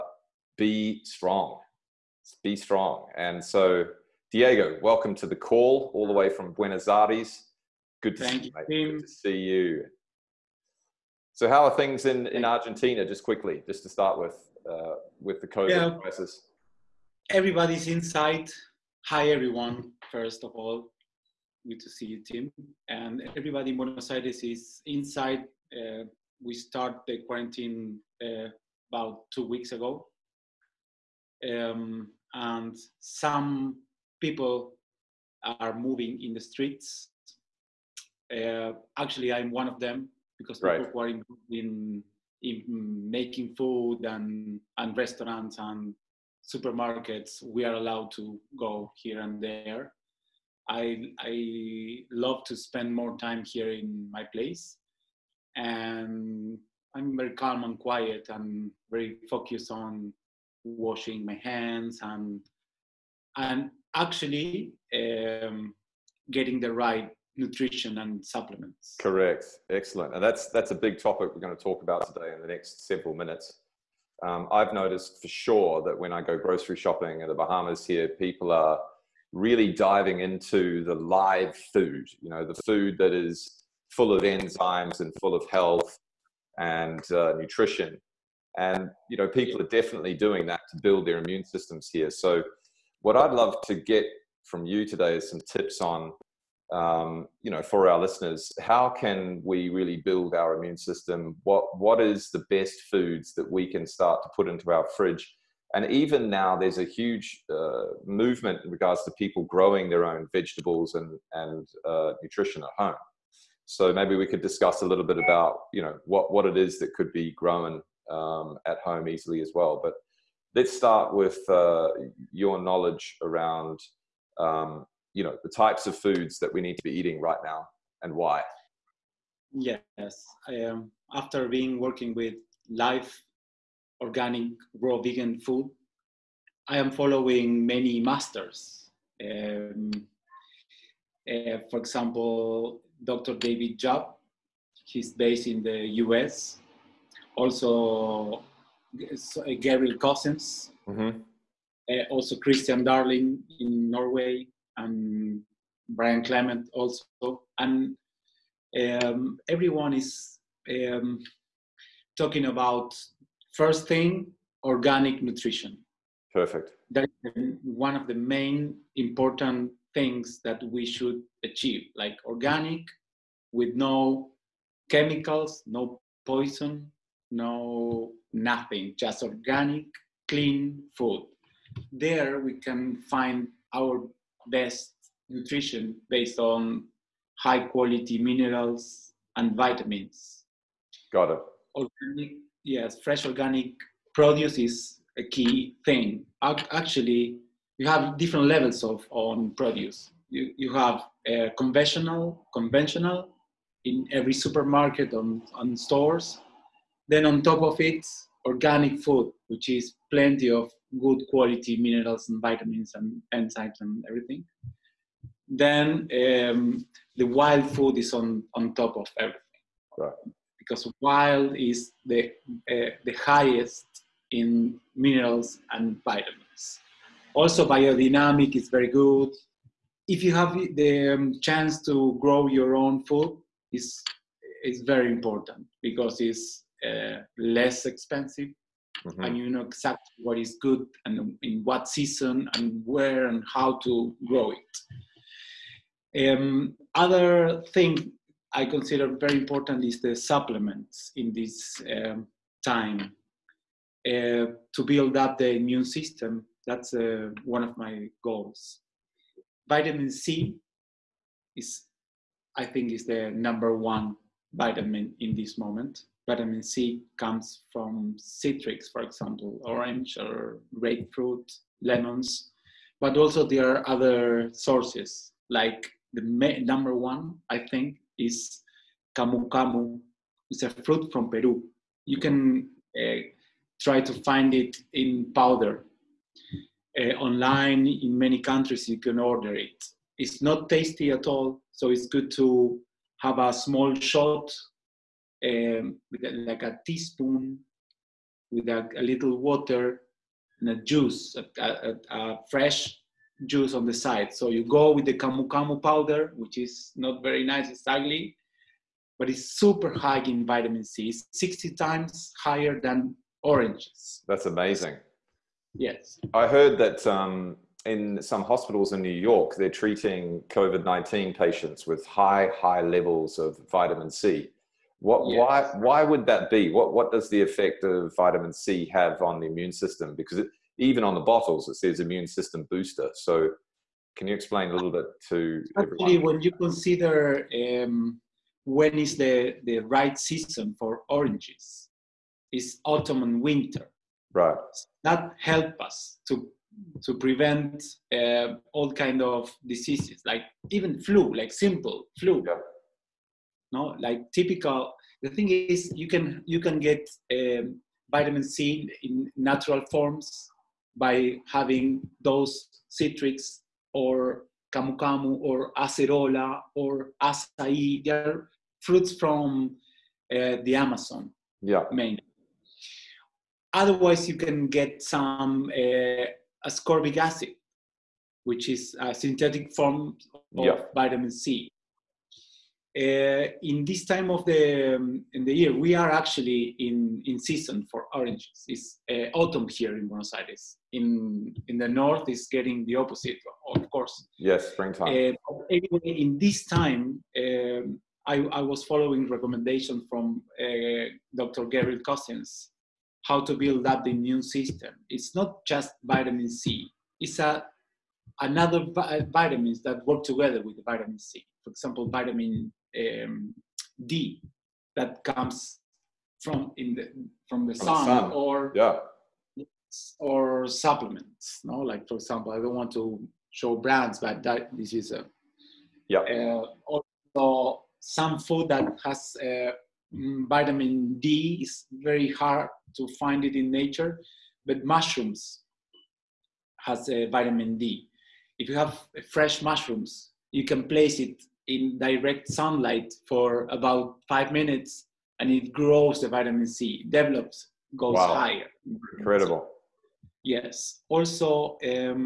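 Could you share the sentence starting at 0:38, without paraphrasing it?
Uh, actually, I'm one of them because right.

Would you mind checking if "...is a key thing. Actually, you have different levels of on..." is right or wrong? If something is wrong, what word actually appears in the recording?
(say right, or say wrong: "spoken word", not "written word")
right.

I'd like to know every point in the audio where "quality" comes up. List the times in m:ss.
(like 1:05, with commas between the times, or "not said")
3:07, 3:31.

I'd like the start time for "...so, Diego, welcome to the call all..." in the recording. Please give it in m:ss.
0:03.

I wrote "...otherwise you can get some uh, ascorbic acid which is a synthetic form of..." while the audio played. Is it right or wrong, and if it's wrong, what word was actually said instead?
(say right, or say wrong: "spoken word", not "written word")
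right.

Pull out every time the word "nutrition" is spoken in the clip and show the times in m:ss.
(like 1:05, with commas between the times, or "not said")
1:07, 1:27, 1:52, 2:45, 3:05.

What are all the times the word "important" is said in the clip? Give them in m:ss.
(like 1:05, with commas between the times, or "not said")
2:48, 3:55, 4:09.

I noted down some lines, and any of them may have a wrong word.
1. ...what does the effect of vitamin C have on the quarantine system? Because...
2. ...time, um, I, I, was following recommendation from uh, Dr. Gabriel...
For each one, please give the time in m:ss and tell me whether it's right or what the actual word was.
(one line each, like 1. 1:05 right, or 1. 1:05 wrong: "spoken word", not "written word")
1. 5:26 wrong: "immune", not "quarantine"
2. 6:36 right.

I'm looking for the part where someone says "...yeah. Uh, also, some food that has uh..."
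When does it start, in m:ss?
7:06.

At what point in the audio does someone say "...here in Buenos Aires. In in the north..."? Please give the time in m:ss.
6:29.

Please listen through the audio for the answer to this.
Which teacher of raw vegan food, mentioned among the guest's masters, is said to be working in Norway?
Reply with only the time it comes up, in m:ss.
2:32.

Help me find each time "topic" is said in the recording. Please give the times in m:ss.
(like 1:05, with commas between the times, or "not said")
1:10.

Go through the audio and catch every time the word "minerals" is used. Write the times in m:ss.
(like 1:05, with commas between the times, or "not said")
3:08, 3:31, 3:44.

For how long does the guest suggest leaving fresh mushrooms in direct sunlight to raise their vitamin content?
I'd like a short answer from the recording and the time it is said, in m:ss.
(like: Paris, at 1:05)
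about five minutes, at 7:23.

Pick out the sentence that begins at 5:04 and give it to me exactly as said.
So you go with the camu camu powder, which is not very nice, it's ugly, but it's super high in vitamin C.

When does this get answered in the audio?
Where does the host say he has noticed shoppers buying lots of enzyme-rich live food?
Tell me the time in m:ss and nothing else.
1:17.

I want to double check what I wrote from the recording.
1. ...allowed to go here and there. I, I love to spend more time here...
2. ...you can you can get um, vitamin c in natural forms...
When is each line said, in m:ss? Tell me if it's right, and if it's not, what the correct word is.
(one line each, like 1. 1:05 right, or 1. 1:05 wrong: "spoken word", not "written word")
1. 0:47 right
2. 5:55 right.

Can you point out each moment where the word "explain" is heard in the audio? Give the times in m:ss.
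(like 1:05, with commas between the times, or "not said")
5:34.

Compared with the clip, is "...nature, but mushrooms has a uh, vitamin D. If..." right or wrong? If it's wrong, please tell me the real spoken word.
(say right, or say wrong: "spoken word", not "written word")
right.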